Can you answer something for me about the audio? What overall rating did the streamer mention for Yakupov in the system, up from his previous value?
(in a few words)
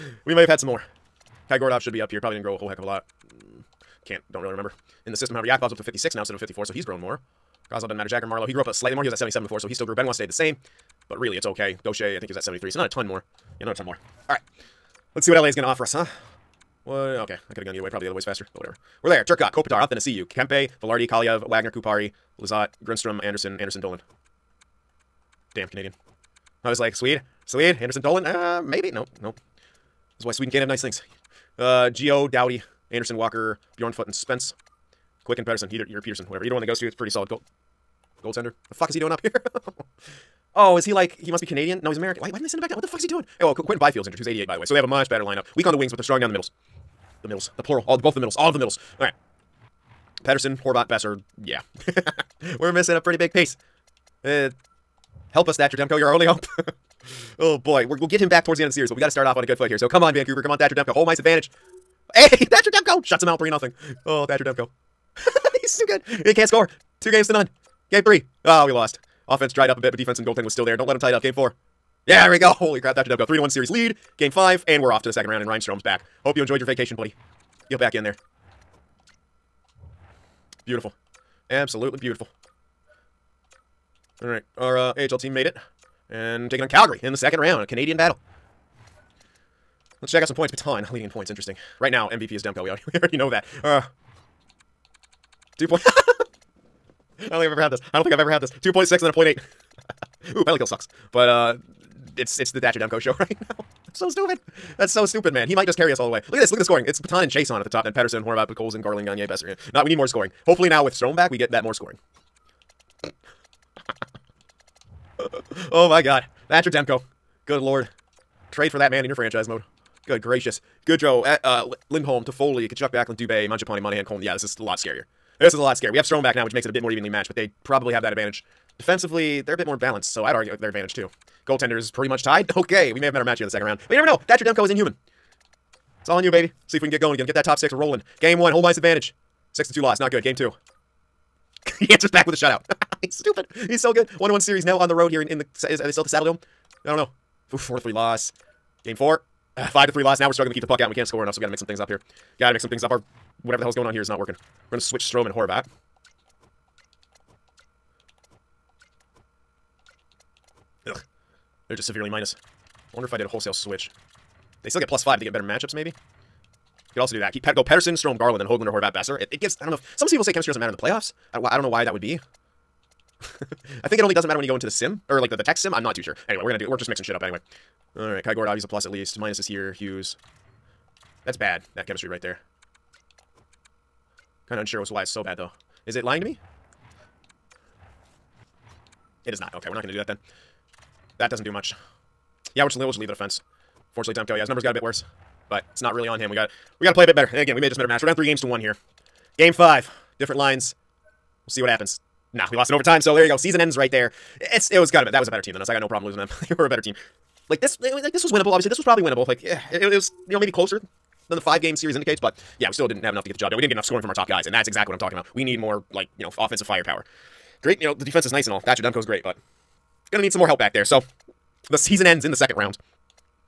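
56.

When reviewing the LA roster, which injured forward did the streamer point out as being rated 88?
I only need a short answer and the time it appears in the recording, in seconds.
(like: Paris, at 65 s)
Quinton Byfield, at 43 s.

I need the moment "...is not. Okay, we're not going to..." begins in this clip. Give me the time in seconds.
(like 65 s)
189 s.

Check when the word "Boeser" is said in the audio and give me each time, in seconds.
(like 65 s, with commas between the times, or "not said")
50 s, 109 s, 168 s.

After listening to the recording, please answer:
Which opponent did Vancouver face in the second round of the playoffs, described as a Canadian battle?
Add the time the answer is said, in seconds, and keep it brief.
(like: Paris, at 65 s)
Calgary, at 86 s.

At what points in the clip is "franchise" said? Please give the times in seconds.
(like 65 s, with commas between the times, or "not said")
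119 s.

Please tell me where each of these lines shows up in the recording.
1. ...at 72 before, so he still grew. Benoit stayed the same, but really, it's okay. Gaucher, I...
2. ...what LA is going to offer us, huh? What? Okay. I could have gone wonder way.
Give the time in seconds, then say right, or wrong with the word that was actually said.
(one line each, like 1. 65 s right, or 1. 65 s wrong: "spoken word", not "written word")
1. 9 s wrong: "77", not "72"
2. 15 s wrong: "either", not "wonder".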